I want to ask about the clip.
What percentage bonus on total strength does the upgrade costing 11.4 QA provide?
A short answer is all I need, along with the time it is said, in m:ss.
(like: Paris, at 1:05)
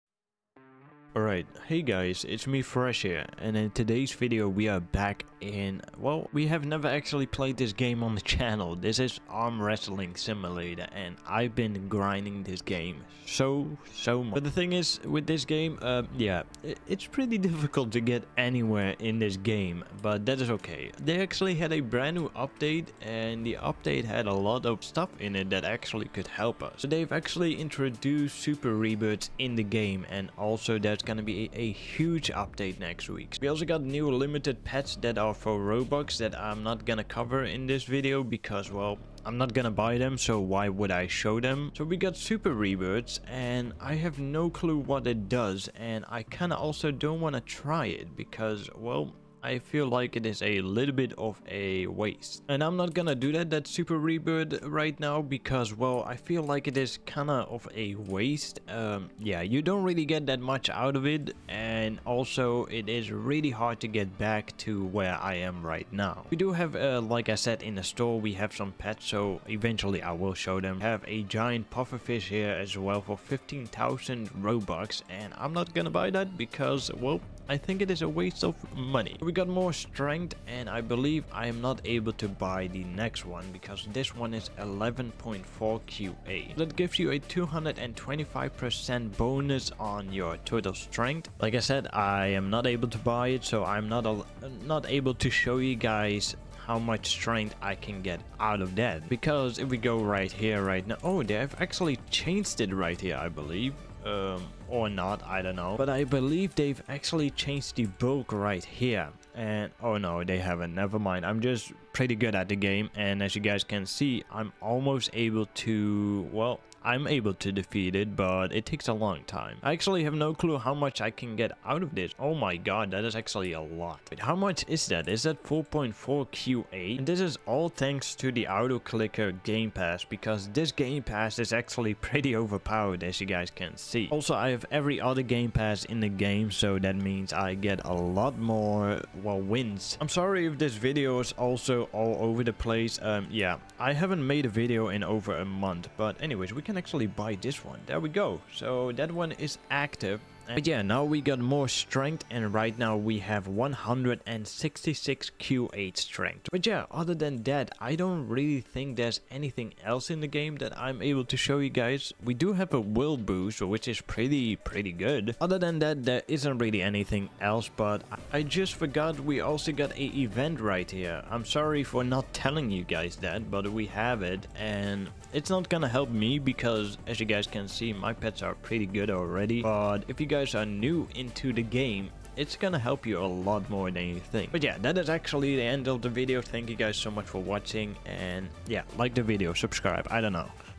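225%, at 1:27.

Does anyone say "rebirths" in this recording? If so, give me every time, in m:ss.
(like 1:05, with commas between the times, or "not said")
0:28, 0:42, 0:53.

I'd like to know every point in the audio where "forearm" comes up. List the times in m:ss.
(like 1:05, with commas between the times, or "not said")
not said.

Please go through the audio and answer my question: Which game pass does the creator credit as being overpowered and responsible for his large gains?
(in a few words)
Auto Clicker.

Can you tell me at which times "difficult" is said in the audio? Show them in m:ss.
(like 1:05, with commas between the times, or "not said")
0:17.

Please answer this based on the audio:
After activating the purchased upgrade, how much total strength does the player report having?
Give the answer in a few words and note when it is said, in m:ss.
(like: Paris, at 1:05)
166 QA, at 2:33.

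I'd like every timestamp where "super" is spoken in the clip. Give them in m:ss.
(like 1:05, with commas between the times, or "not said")
0:28, 0:42, 0:53.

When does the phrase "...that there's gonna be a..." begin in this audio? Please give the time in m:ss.
0:30.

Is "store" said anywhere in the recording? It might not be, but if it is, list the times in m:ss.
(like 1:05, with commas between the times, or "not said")
1:07.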